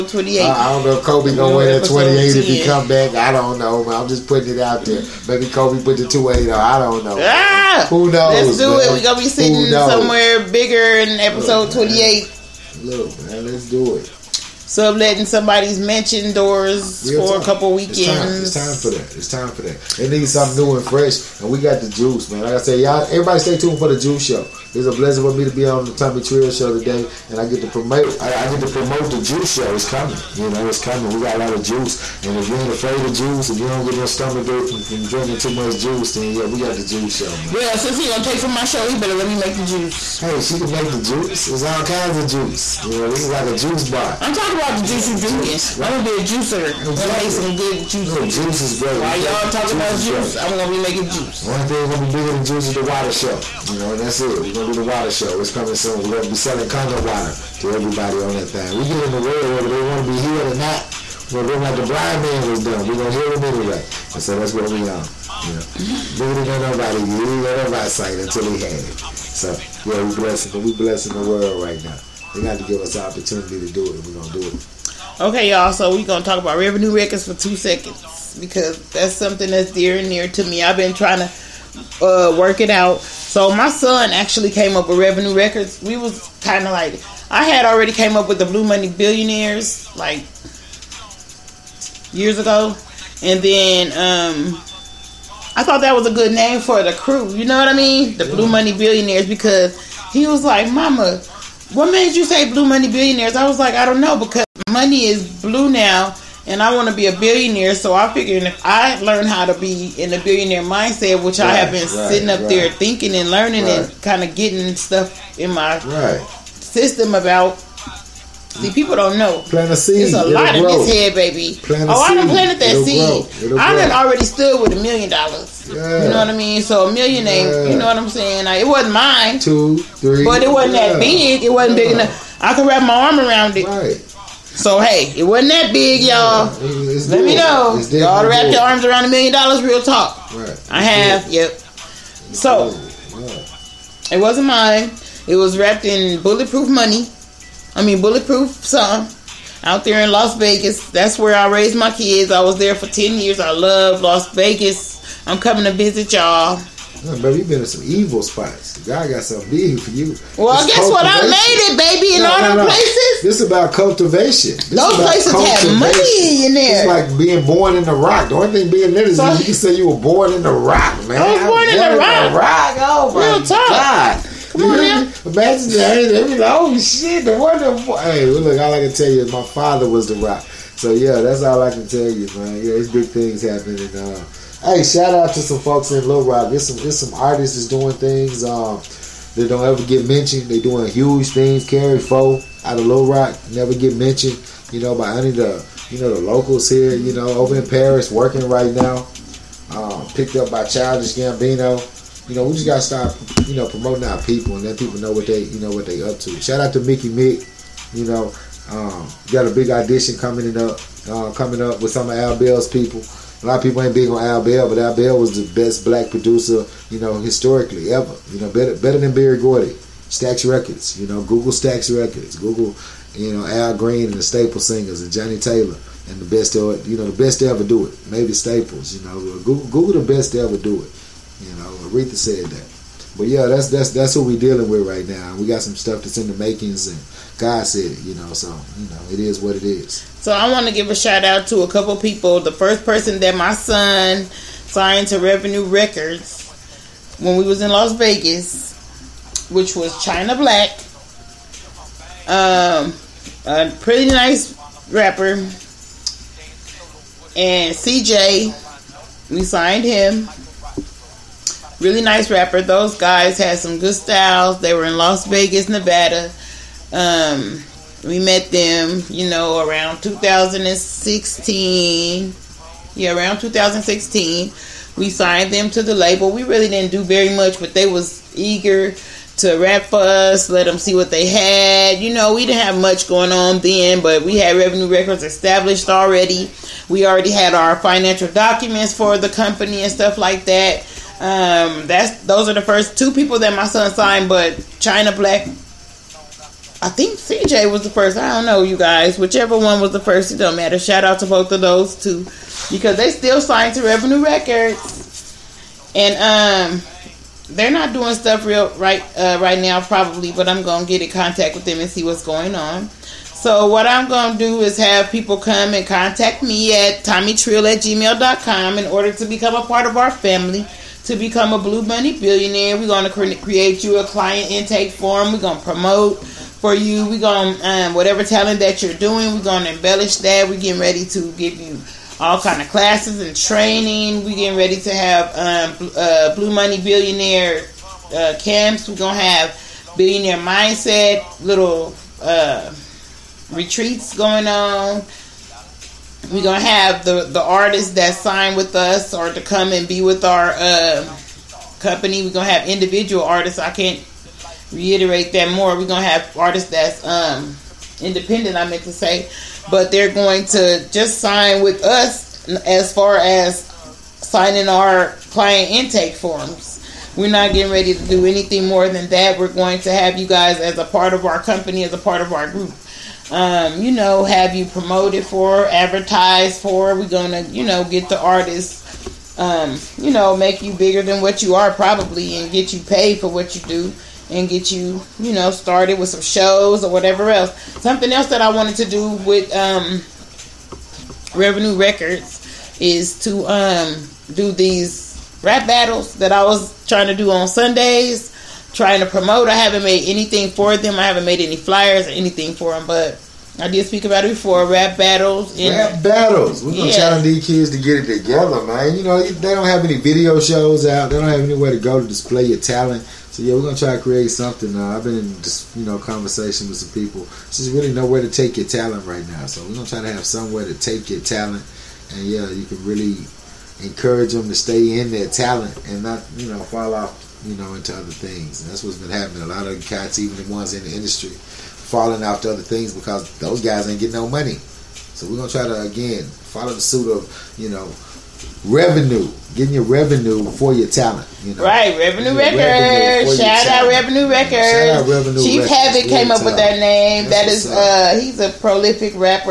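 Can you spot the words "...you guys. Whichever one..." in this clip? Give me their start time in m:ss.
4:58.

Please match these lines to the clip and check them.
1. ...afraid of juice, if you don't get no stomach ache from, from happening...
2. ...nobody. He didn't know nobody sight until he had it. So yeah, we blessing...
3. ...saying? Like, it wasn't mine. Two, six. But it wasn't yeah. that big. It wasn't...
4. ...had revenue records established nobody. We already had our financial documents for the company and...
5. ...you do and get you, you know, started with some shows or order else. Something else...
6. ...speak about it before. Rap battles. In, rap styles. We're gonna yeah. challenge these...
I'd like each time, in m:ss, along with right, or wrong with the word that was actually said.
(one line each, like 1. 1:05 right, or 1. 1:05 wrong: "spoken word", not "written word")
1. 0:32 wrong: "drinking", not "happening"
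2. 1:06 right
3. 2:08 wrong: "three", not "six"
4. 4:44 wrong: "already", not "nobody"
5. 6:23 wrong: "whatever", not "order"
6. 6:43 wrong: "battles", not "styles".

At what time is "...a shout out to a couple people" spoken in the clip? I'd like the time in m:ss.
4:00.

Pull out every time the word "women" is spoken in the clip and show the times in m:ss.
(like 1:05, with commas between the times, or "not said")
not said.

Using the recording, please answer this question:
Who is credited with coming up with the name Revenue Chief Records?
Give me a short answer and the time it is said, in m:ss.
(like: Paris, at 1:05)
Havoc, at 7:25.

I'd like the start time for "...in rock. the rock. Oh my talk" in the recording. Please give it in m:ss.
2:51.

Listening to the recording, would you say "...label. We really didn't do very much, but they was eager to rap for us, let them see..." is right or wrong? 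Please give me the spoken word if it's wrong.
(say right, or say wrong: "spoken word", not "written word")
right.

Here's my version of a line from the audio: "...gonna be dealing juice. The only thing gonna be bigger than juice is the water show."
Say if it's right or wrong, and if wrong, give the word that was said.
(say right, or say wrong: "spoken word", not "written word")
wrong: "making", not "dealing".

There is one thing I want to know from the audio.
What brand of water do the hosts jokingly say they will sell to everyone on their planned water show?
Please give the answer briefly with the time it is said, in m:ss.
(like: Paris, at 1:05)
Kangen, at 0:56.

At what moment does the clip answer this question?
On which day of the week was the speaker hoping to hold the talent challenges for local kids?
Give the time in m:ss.
6:37.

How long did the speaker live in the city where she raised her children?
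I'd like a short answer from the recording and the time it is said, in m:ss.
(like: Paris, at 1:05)
10 years, at 2:32.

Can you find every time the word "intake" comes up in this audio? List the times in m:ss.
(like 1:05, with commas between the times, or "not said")
5:24, 6:05.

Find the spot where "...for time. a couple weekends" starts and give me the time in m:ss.
0:17.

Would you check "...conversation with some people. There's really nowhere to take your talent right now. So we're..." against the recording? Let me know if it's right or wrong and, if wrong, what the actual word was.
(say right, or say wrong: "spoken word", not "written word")
right.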